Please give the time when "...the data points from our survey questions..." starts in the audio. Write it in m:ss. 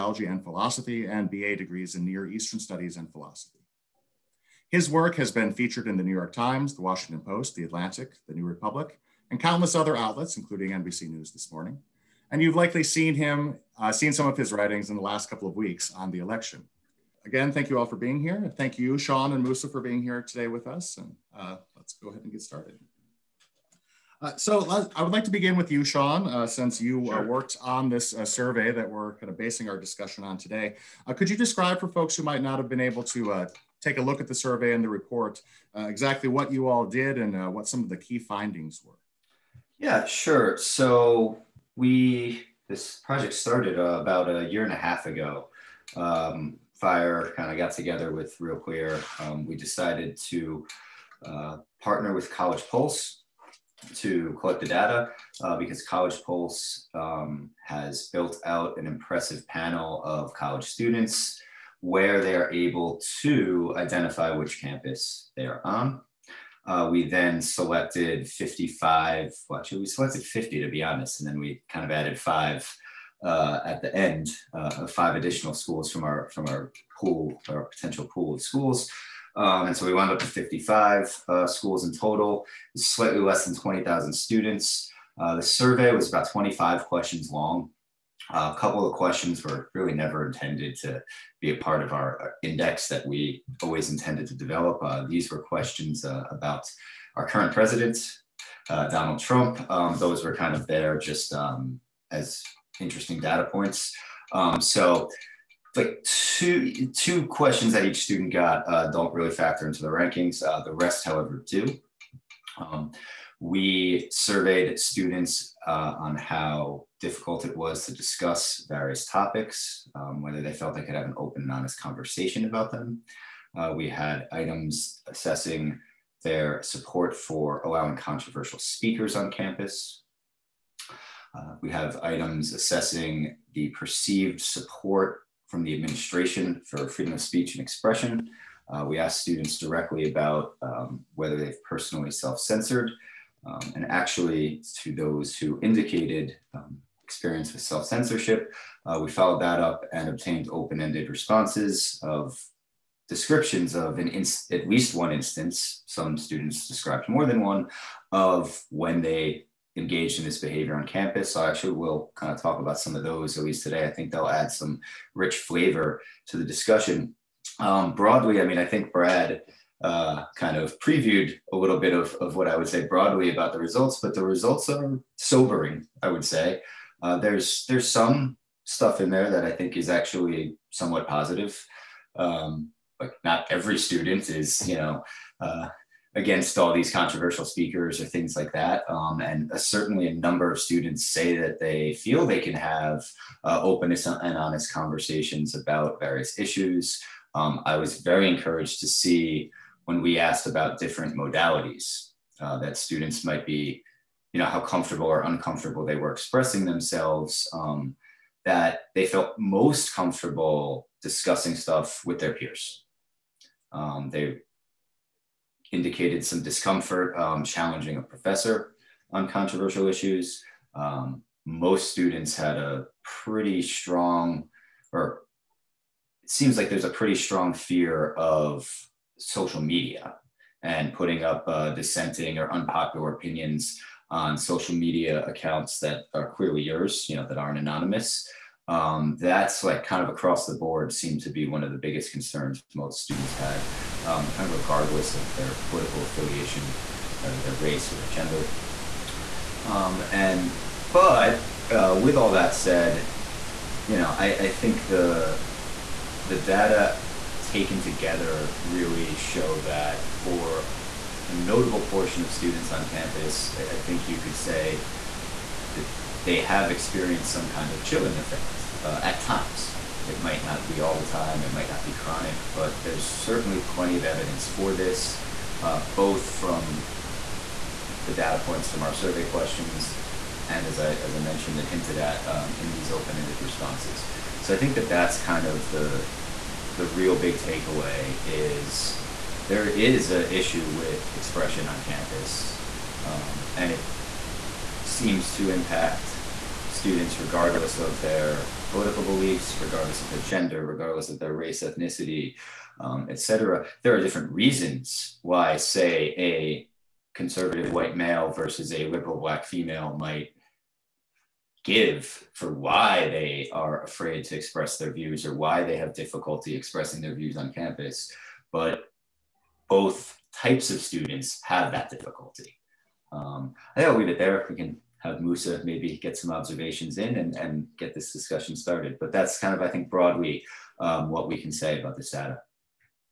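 4:38.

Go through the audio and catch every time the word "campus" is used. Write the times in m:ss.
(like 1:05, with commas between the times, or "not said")
1:04, 2:09, 2:40, 4:22, 4:51, 5:17.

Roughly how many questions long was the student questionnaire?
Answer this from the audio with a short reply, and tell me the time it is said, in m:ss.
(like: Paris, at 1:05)
25, at 1:26.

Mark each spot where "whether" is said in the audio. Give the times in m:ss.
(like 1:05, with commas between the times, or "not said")
2:00, 2:21.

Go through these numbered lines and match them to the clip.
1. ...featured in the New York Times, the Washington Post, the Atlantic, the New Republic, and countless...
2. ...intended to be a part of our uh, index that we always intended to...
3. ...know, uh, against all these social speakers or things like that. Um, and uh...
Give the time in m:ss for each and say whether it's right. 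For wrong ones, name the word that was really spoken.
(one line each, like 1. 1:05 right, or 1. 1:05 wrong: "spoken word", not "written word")
1. 0:05 right
2. 1:30 right
3. 3:04 wrong: "controversial", not "social".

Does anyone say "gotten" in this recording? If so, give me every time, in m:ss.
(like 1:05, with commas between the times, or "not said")
not said.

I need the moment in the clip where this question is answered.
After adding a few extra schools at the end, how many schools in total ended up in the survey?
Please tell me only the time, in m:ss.
1:20.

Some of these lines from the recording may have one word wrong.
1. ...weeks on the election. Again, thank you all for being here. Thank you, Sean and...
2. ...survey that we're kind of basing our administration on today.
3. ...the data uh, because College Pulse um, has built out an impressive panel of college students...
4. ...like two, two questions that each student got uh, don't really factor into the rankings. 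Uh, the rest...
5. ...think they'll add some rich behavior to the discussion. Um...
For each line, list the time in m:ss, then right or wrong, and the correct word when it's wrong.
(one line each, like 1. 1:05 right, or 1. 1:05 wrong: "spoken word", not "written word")
1. 0:15 right
2. 0:28 wrong: "discussion", not "administration"
3. 0:54 right
4. 1:45 right
5. 2:43 wrong: "flavor", not "behavior".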